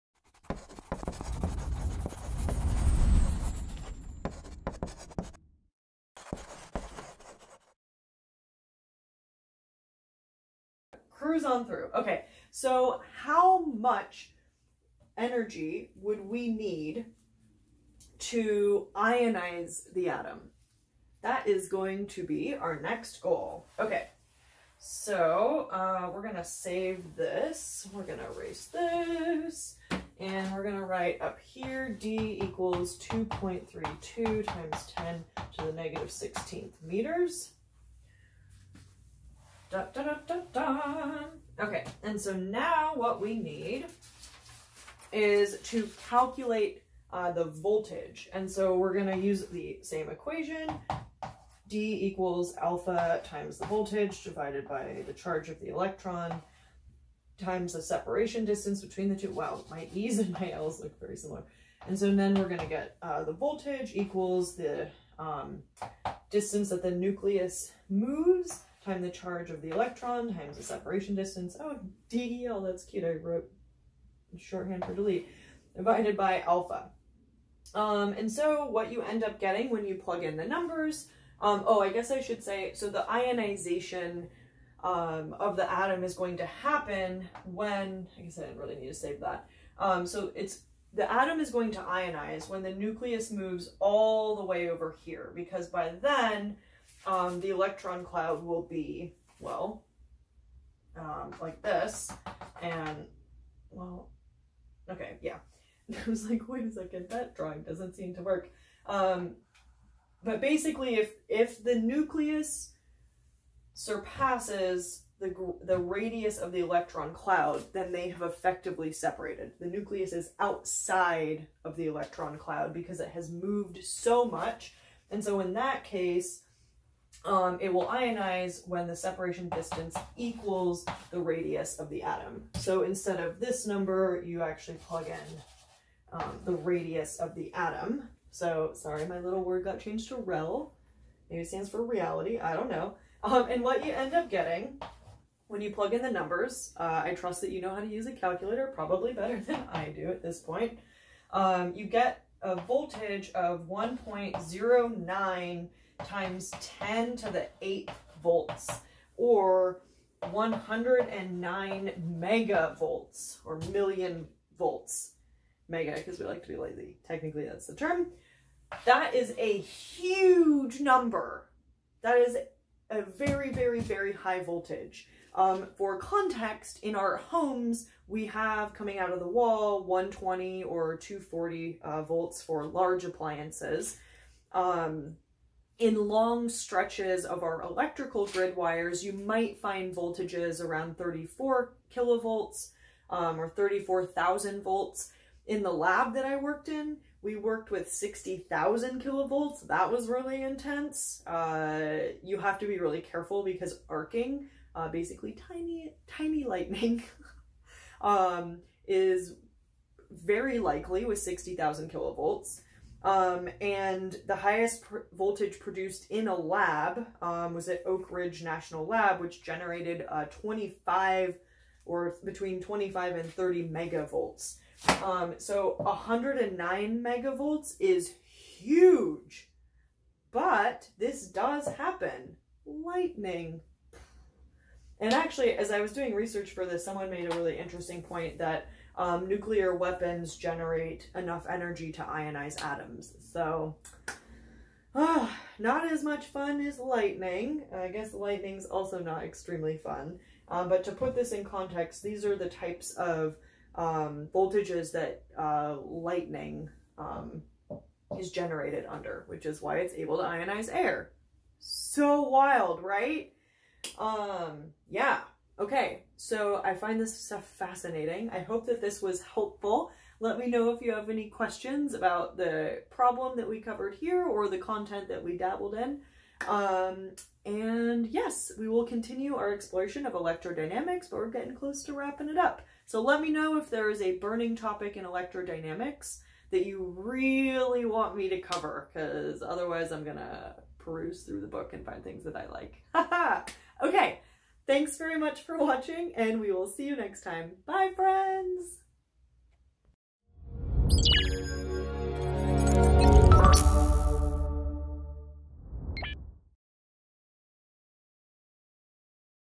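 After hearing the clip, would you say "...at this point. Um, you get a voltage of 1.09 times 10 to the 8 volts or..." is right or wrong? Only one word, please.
right.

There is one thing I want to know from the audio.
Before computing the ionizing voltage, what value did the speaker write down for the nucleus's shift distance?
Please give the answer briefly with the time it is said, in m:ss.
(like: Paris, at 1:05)
2.32 times 10^-16 meters, at 0:32.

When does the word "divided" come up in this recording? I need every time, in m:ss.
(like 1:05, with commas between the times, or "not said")
0:54, 1:15.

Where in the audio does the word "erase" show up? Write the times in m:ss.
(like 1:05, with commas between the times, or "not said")
0:28.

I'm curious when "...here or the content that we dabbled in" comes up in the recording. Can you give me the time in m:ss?
4:33.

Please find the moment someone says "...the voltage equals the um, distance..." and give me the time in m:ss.
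1:03.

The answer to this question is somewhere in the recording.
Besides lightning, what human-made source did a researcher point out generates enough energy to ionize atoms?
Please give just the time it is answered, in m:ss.
3:59.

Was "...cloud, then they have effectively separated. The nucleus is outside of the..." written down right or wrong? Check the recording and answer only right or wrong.
right.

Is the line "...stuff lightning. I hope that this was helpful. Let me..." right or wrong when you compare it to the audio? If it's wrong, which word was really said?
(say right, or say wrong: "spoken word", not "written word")
wrong: "fascinating", not "lightning".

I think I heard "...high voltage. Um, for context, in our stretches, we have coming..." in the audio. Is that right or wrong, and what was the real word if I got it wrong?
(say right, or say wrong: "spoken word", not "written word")
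wrong: "homes", not "stretches".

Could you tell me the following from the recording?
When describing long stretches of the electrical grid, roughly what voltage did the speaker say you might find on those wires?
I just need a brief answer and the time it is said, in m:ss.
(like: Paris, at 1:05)
34 kilovolts, at 3:10.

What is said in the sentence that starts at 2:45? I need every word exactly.
Mega, because we like to be lazy.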